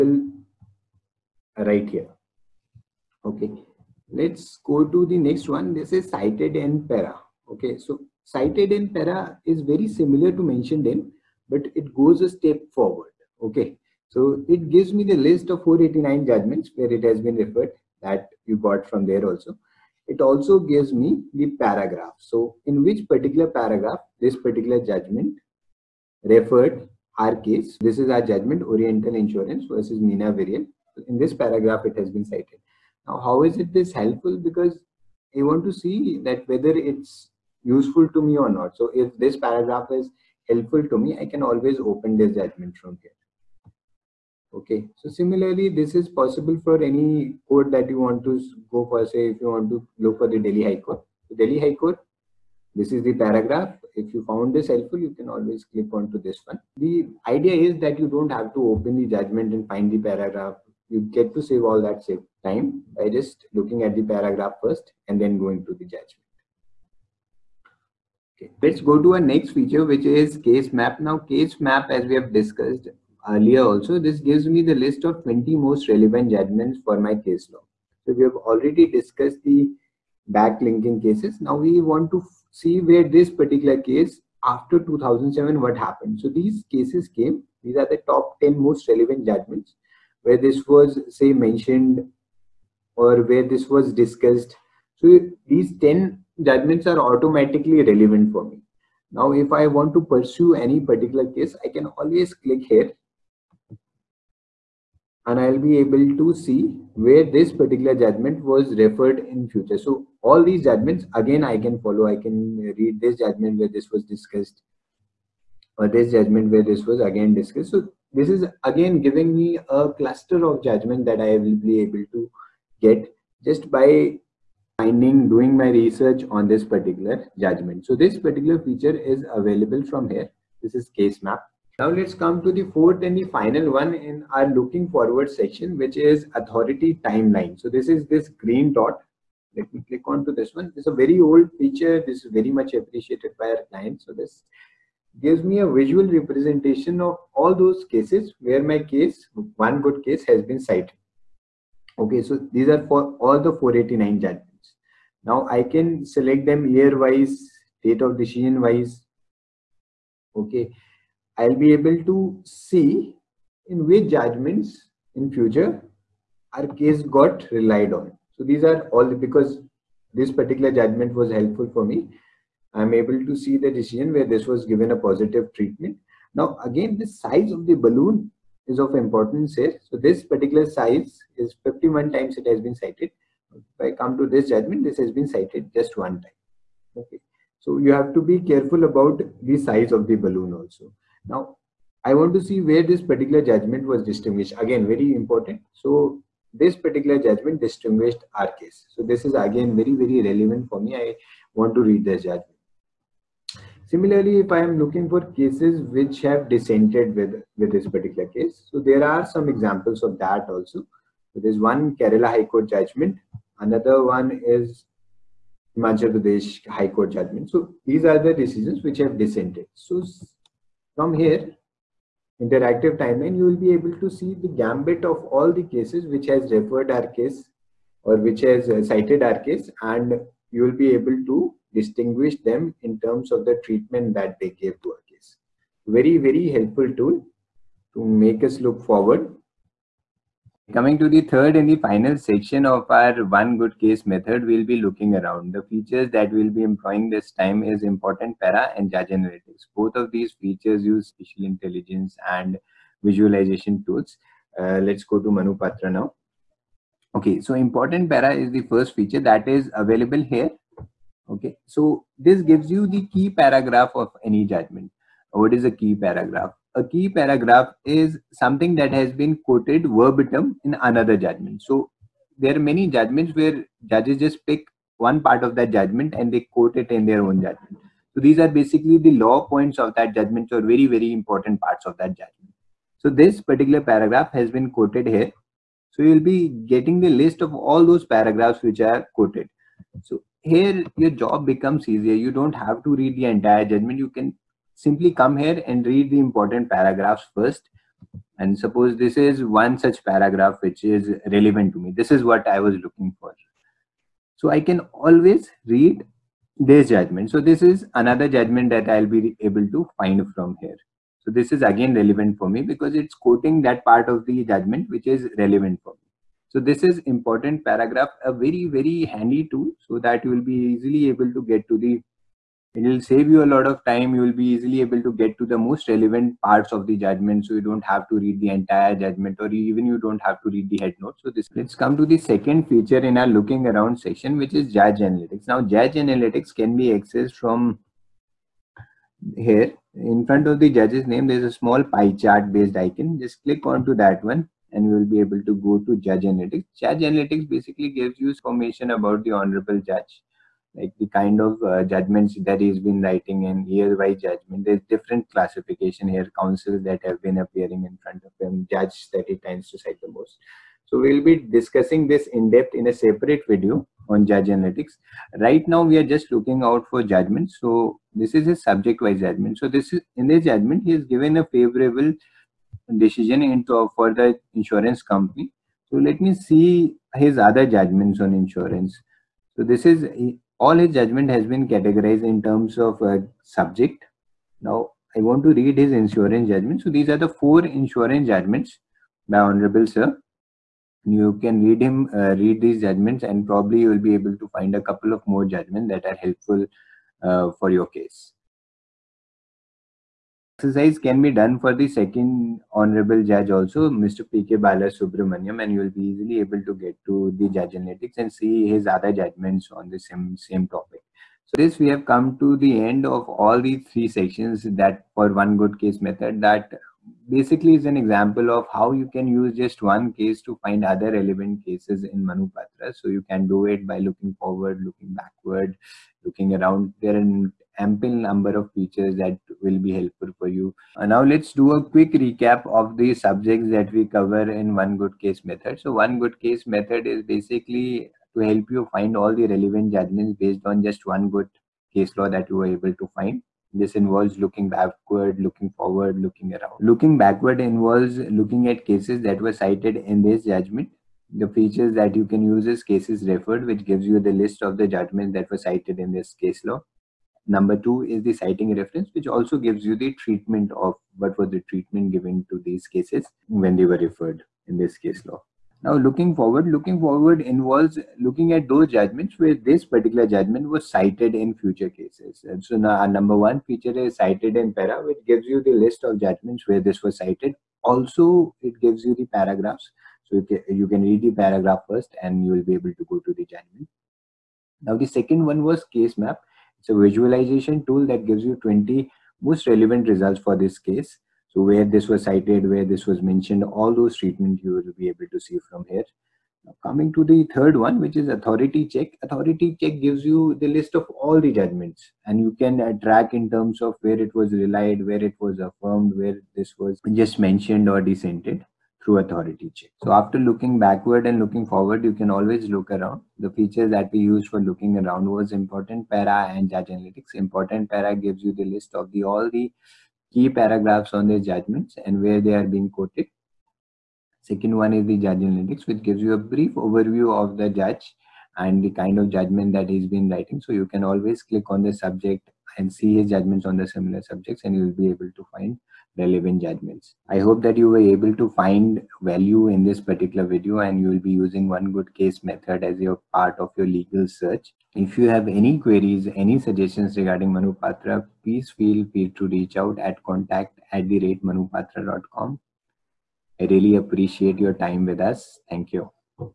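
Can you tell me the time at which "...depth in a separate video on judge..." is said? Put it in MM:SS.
06:02.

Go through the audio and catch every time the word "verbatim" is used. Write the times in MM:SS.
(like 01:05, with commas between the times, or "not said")
04:29.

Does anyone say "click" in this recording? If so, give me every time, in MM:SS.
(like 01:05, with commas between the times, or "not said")
00:55, 01:42, 02:19, 05:43, 08:51.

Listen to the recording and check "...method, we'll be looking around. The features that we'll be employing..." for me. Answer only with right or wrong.
right.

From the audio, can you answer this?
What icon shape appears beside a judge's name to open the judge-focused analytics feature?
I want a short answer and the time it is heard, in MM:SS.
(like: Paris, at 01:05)
pie chart, at 05:41.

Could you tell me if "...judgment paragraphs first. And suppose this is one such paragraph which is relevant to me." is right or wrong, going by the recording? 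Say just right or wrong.
wrong.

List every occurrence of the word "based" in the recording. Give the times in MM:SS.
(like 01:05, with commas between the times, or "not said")
05:42, 07:20.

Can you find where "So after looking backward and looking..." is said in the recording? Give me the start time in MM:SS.
08:30.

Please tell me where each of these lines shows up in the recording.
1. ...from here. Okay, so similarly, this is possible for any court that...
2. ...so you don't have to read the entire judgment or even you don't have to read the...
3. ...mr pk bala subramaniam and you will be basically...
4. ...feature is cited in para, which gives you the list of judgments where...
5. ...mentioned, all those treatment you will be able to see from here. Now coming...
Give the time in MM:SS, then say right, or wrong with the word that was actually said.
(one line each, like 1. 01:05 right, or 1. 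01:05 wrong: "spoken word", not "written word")
1. 00:42 right
2. 05:27 right
3. 06:44 wrong: "easily", not "basically"
4. 07:53 right
5. 08:13 right.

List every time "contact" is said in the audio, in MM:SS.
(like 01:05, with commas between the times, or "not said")
09:10.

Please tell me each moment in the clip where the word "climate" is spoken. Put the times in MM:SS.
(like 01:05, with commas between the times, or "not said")
not said.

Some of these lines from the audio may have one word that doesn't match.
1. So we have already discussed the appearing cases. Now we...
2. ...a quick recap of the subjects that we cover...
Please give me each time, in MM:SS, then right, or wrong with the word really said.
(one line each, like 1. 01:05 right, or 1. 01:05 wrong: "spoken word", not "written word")
1. 01:18 wrong: "backlinking", not "appearing"
2. 07:11 right.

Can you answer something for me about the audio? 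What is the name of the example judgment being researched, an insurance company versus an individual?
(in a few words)
Oriental Insurance versus Meena Variyal.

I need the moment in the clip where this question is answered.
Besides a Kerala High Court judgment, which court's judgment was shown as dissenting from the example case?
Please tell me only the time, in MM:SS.
03:35.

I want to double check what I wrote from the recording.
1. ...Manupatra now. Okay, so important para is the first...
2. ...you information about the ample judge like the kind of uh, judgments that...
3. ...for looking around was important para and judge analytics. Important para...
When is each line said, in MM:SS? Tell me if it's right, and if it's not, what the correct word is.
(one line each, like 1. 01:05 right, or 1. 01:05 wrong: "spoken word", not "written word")
1. 04:15 right
2. 05:48 wrong: "honorable", not "ample"
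3. 08:34 right.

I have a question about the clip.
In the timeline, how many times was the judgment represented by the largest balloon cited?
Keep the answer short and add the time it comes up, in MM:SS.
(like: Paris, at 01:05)
51, at 03:01.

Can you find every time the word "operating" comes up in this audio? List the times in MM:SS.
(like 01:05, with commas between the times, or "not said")
not said.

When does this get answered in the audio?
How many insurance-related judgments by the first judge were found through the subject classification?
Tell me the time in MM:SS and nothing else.
06:27.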